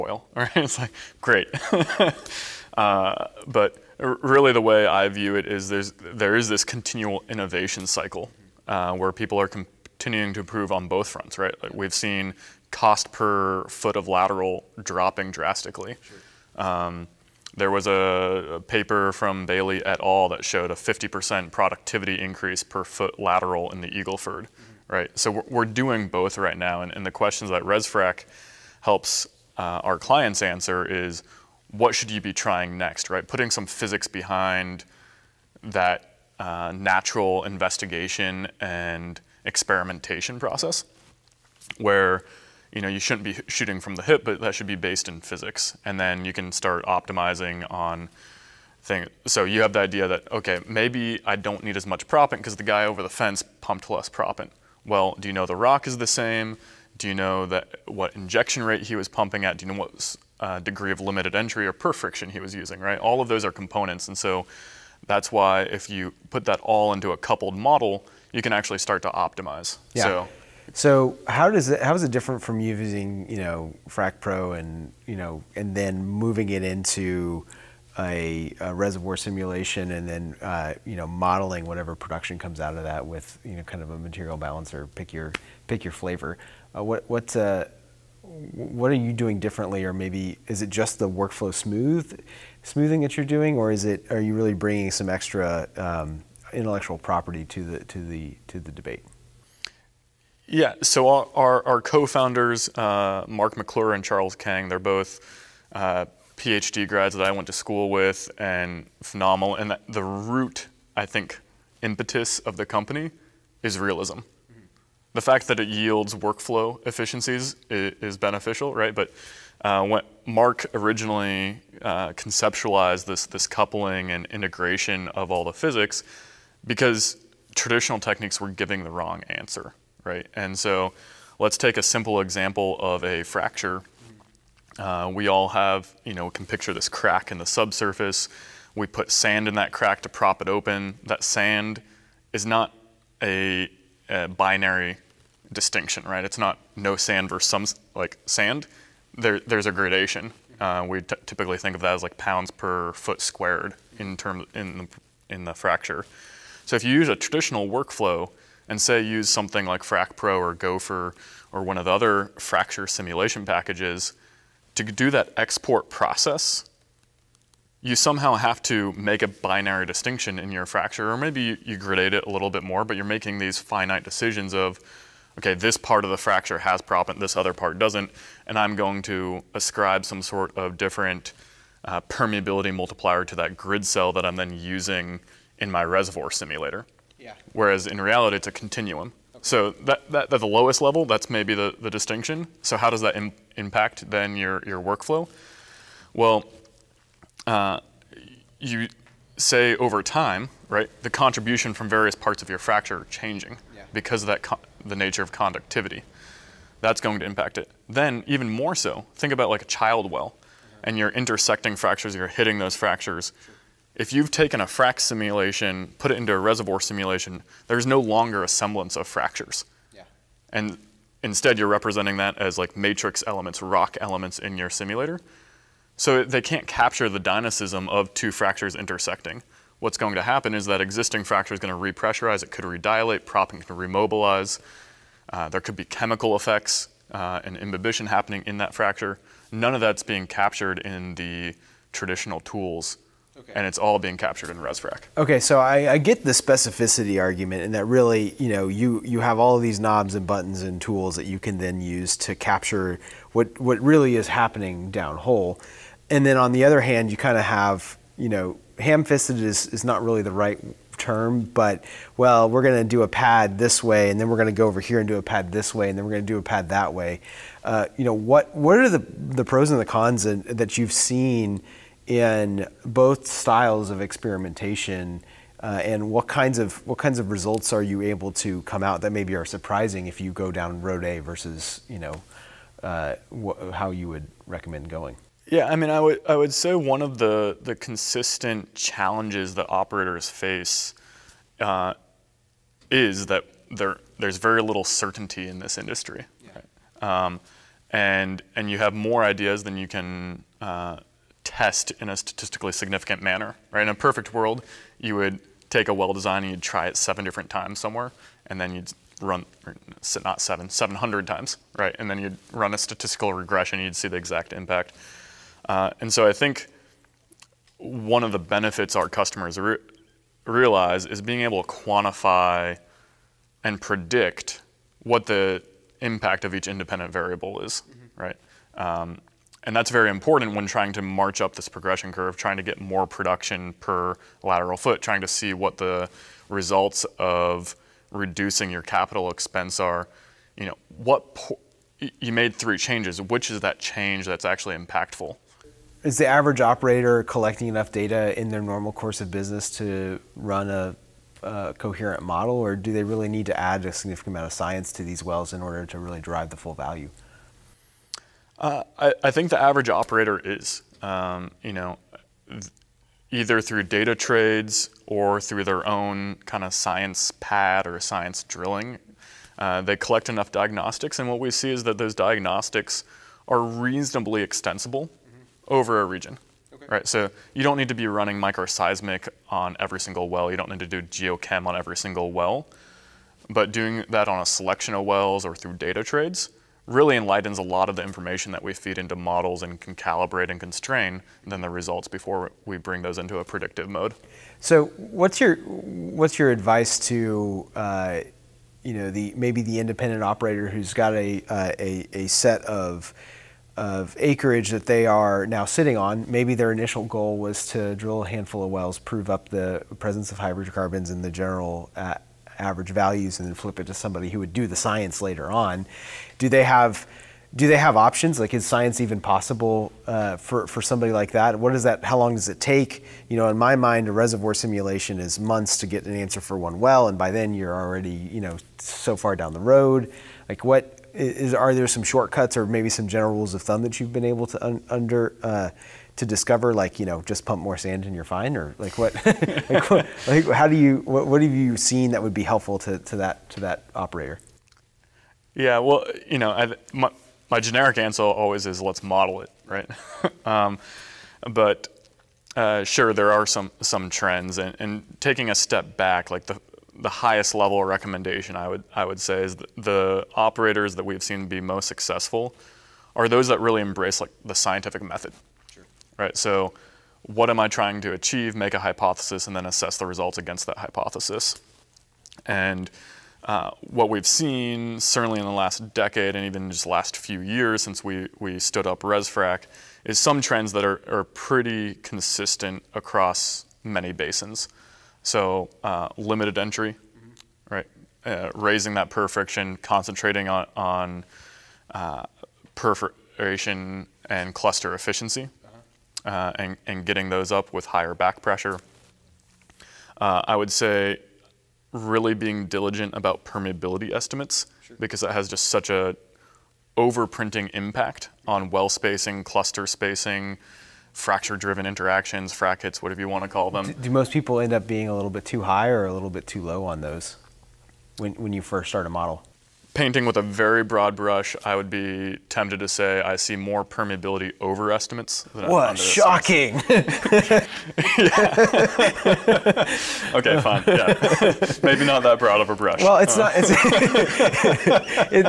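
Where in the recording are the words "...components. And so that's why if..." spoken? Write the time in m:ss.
1:03.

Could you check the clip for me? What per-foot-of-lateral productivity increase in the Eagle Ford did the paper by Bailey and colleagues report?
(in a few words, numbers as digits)
50%.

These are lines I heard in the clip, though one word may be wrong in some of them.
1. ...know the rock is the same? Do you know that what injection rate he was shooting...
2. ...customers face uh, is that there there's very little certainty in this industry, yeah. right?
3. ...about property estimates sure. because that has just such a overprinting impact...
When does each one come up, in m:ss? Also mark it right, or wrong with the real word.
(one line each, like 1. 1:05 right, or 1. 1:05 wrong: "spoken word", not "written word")
1. 0:55 wrong: "pumping", not "shooting"
2. 4:49 wrong: "operators", not "customers"
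3. 8:23 wrong: "permeability", not "property".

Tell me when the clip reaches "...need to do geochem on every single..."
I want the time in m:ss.
6:20.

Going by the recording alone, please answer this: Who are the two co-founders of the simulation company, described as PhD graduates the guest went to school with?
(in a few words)
Mark McClure and Charles Kang.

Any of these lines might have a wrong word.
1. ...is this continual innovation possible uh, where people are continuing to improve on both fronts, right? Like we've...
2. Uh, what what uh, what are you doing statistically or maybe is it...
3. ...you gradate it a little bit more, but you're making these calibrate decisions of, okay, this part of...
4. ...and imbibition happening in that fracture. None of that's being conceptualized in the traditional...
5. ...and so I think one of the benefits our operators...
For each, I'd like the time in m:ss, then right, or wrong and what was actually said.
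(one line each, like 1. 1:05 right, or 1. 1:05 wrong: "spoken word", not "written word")
1. 0:06 wrong: "cycle", not "possible"
2. 1:26 wrong: "differently", not "statistically"
3. 2:51 wrong: "finite", not "calibrate"
4. 3:57 wrong: "captured", not "conceptualized"
5. 5:16 wrong: "customers", not "operators".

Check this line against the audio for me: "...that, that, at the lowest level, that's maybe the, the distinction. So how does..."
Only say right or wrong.
right.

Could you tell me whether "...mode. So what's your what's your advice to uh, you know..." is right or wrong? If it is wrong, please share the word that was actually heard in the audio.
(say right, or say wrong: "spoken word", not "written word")
right.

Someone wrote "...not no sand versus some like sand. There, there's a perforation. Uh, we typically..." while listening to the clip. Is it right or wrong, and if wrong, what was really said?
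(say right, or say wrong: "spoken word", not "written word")
wrong: "gradation", not "perforation".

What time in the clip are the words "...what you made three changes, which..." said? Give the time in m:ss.
5:40.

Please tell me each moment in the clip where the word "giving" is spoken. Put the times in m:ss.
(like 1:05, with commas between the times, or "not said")
2:08.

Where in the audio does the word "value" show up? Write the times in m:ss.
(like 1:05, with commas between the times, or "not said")
5:56, 6:52.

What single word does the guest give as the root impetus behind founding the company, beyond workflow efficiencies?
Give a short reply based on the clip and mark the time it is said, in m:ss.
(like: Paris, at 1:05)
Realism, at 1:53.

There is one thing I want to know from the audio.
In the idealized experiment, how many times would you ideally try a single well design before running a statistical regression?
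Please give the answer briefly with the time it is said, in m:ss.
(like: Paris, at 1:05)
700, at 5:10.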